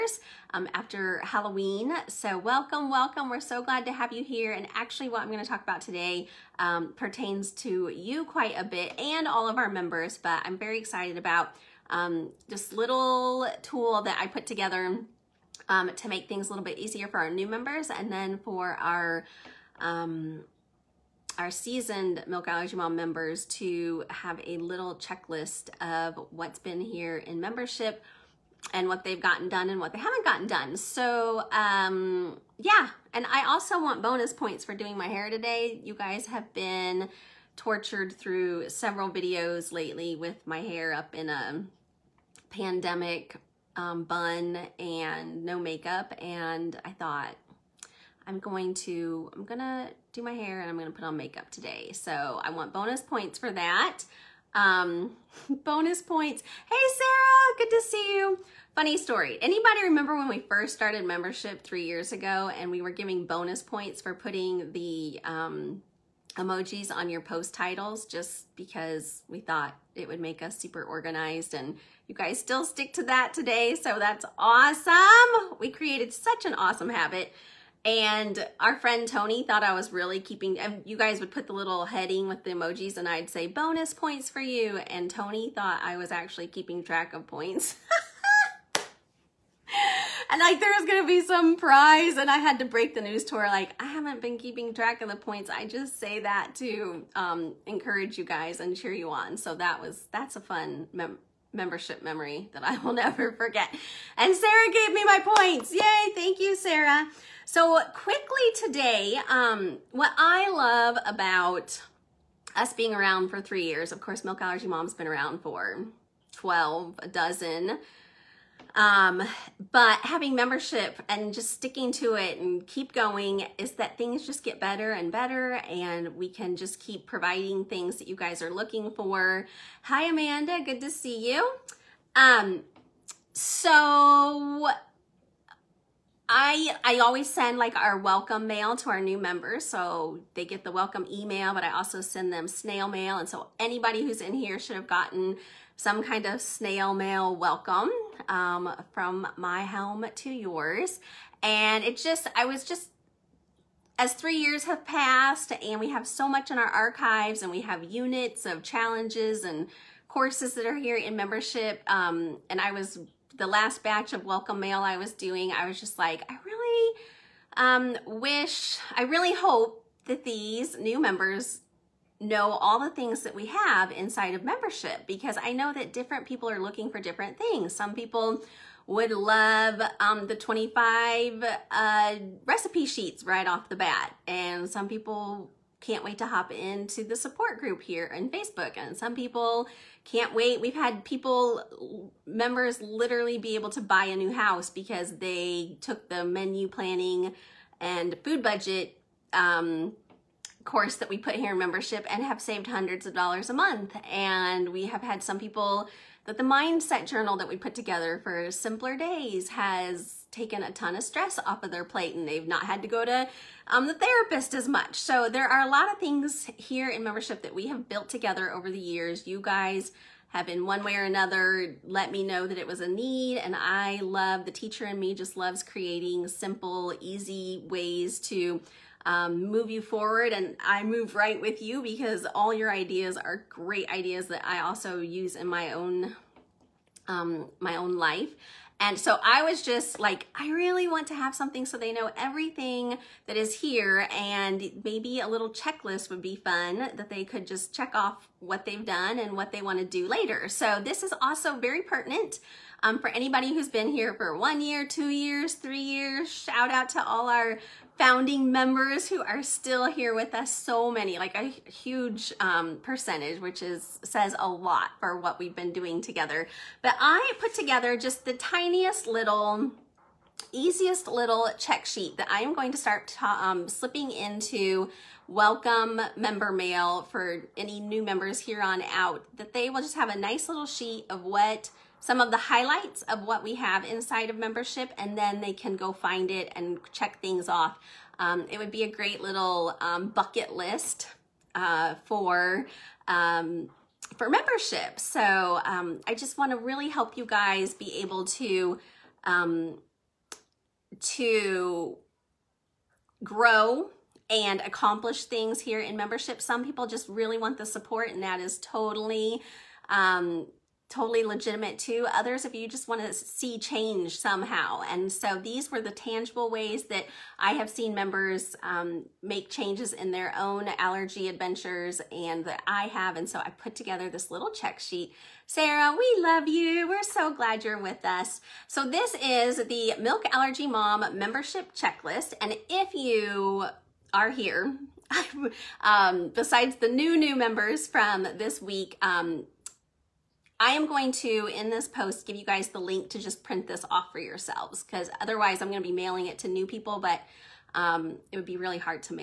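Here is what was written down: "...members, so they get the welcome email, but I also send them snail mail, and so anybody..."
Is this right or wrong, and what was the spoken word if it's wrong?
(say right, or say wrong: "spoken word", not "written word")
right.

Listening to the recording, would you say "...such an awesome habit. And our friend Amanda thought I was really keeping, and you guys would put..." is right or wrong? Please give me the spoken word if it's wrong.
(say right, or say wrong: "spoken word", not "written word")
wrong: "Tony", not "Amanda".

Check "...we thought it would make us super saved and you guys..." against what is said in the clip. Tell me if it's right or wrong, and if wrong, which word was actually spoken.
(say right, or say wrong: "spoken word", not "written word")
wrong: "organized", not "saved".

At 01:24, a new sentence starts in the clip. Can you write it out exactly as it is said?
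And Tony thought I was actually keeping track of points.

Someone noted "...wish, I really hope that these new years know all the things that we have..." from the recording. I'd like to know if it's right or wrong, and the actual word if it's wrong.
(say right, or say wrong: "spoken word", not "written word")
wrong: "members", not "years".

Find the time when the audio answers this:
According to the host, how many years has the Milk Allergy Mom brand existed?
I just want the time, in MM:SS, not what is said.
01:56.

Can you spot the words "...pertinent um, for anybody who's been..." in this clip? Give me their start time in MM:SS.
04:11.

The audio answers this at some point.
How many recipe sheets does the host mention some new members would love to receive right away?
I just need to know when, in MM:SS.
03:00.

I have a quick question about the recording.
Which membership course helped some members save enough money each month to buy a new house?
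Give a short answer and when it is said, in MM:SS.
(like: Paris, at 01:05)
Menu planning and food budget, at 03:16.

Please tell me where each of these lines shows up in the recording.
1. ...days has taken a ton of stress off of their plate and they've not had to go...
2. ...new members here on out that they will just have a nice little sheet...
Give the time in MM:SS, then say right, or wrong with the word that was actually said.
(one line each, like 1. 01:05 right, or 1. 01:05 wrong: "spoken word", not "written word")
1. 03:28 right
2. 04:37 right.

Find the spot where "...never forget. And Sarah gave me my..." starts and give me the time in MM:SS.
01:42.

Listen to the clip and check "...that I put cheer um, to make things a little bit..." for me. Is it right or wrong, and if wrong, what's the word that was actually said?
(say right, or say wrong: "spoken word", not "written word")
wrong: "together", not "cheer".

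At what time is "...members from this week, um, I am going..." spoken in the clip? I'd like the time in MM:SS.
05:37.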